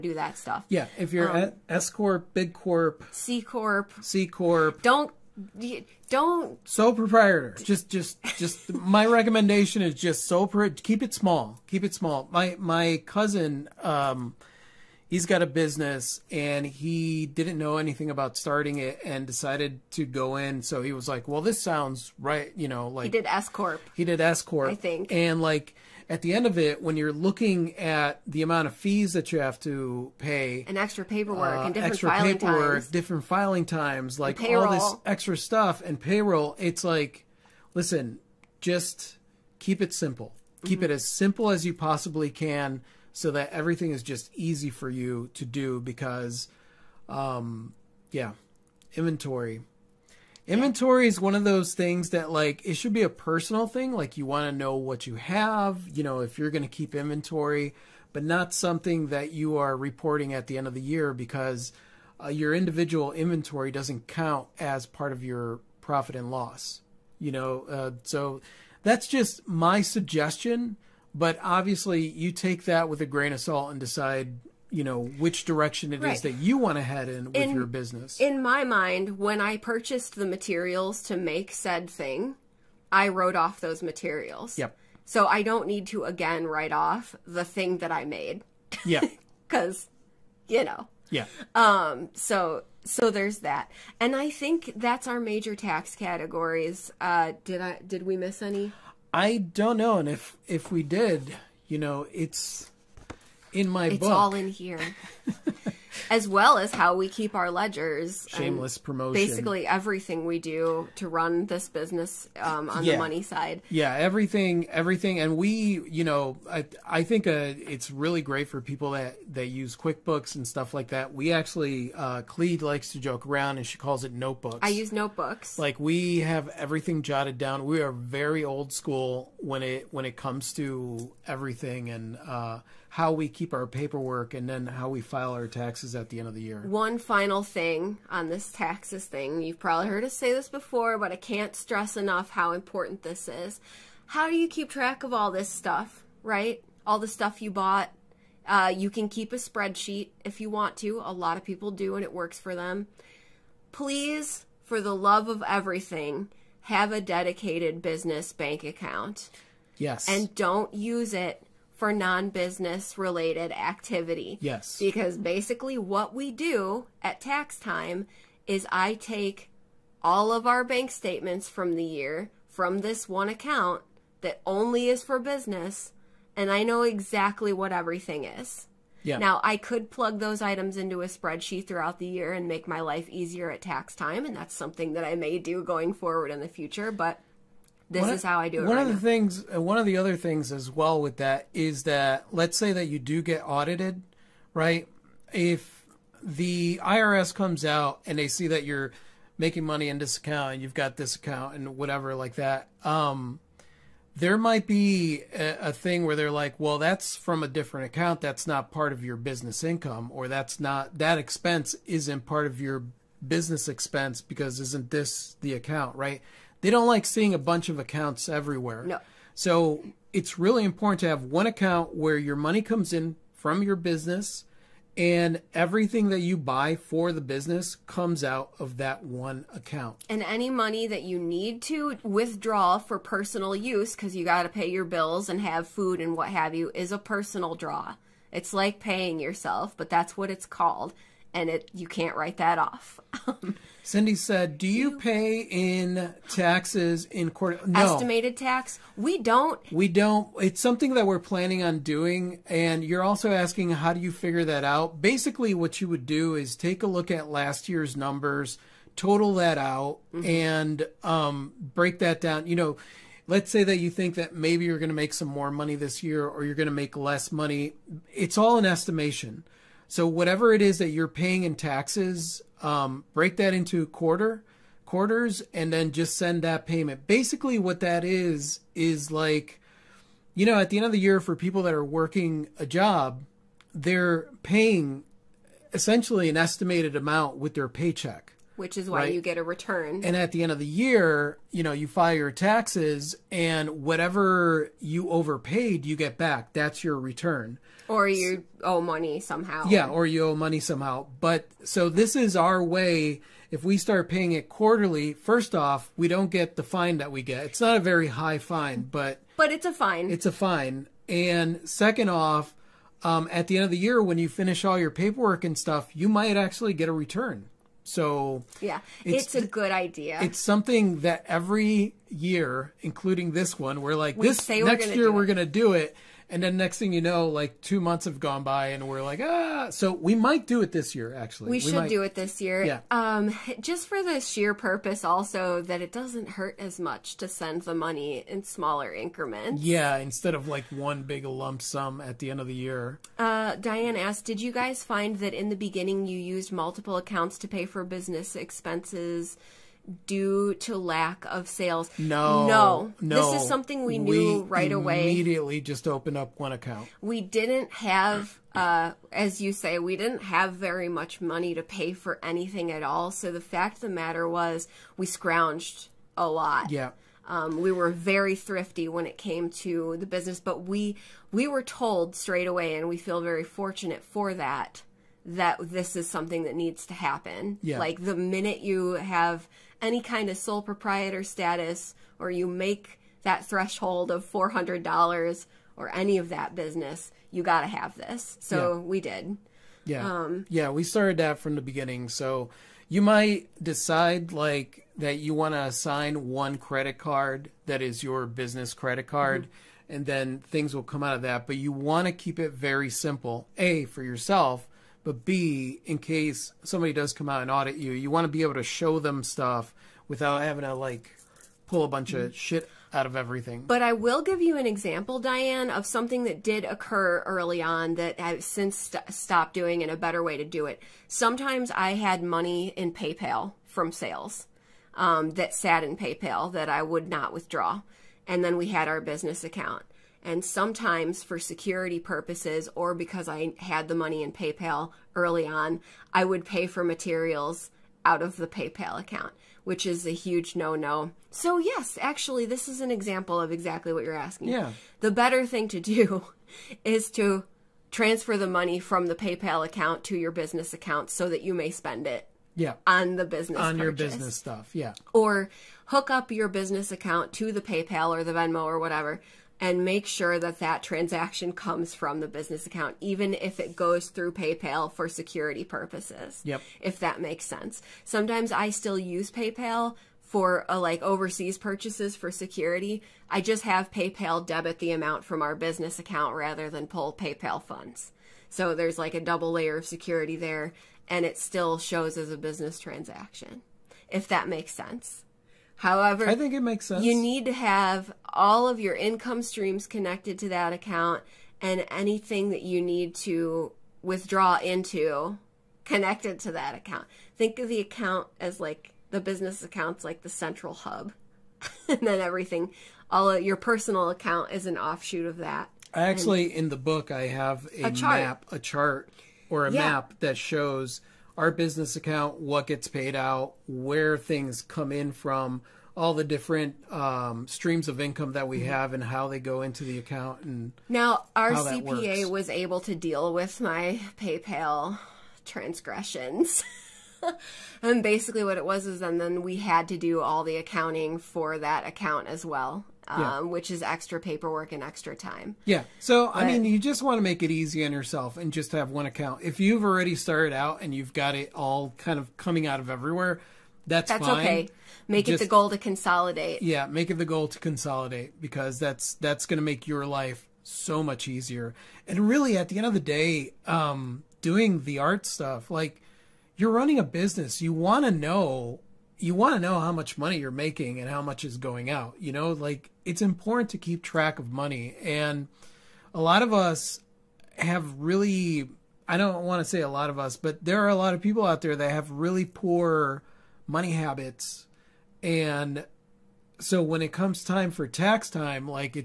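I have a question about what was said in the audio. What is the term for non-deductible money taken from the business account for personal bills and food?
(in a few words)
personal draw.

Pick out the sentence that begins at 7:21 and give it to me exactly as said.
So yes, actually, this is an example of exactly what you're asking.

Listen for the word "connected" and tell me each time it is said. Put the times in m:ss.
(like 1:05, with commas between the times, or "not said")
8:09, 8:15.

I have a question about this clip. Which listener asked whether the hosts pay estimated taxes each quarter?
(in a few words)
Cindy.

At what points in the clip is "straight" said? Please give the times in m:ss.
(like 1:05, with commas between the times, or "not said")
6:12.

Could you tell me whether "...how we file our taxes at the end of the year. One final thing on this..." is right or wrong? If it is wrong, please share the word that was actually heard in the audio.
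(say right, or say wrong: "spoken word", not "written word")
right.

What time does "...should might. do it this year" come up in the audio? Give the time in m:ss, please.
5:31.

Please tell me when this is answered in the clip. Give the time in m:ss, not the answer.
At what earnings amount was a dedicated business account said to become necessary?
6:24.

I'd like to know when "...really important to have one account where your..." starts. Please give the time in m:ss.
3:40.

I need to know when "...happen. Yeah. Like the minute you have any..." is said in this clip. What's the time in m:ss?
6:16.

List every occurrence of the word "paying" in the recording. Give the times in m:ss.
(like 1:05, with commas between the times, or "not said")
3:58, 4:31, 4:44, 5:04.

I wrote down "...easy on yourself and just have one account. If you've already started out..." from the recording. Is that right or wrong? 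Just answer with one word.
right.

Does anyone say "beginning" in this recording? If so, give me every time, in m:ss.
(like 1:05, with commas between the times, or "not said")
5:45, 6:31.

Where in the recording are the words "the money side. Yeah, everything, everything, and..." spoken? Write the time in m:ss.
1:52.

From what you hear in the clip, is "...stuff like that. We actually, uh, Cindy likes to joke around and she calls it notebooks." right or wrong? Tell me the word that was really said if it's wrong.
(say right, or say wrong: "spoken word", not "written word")
wrong: "Cleed", not "Cindy".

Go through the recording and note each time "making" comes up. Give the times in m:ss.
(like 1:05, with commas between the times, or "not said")
3:19, 9:20.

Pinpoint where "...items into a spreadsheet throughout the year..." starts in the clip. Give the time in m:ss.
3:00.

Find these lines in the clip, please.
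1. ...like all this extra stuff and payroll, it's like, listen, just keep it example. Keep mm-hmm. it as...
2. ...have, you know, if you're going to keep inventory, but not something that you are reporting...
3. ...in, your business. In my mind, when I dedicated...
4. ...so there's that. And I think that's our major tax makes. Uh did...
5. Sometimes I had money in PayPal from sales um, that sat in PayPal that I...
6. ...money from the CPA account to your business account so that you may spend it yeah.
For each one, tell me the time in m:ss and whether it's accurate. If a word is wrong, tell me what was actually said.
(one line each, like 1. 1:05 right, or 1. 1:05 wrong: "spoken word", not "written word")
1. 0:34 wrong: "simple", not "example"
2. 0:55 right
3. 1:17 wrong: "purchased", not "dedicated"
4. 1:32 wrong: "categories", not "makes"
5. 7:01 right
6. 7:28 wrong: "PayPal", not "CPA".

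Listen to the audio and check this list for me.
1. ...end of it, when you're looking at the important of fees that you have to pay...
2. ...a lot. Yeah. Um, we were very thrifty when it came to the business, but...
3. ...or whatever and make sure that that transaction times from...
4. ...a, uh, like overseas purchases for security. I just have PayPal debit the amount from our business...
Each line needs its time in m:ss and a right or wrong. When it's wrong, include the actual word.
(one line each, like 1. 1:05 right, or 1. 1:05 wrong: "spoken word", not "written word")
1. 0:26 wrong: "amount", not "important"
2. 6:06 right
3. 7:38 wrong: "comes", not "times"
4. 7:50 right.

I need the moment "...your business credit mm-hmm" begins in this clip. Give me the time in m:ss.
6:38.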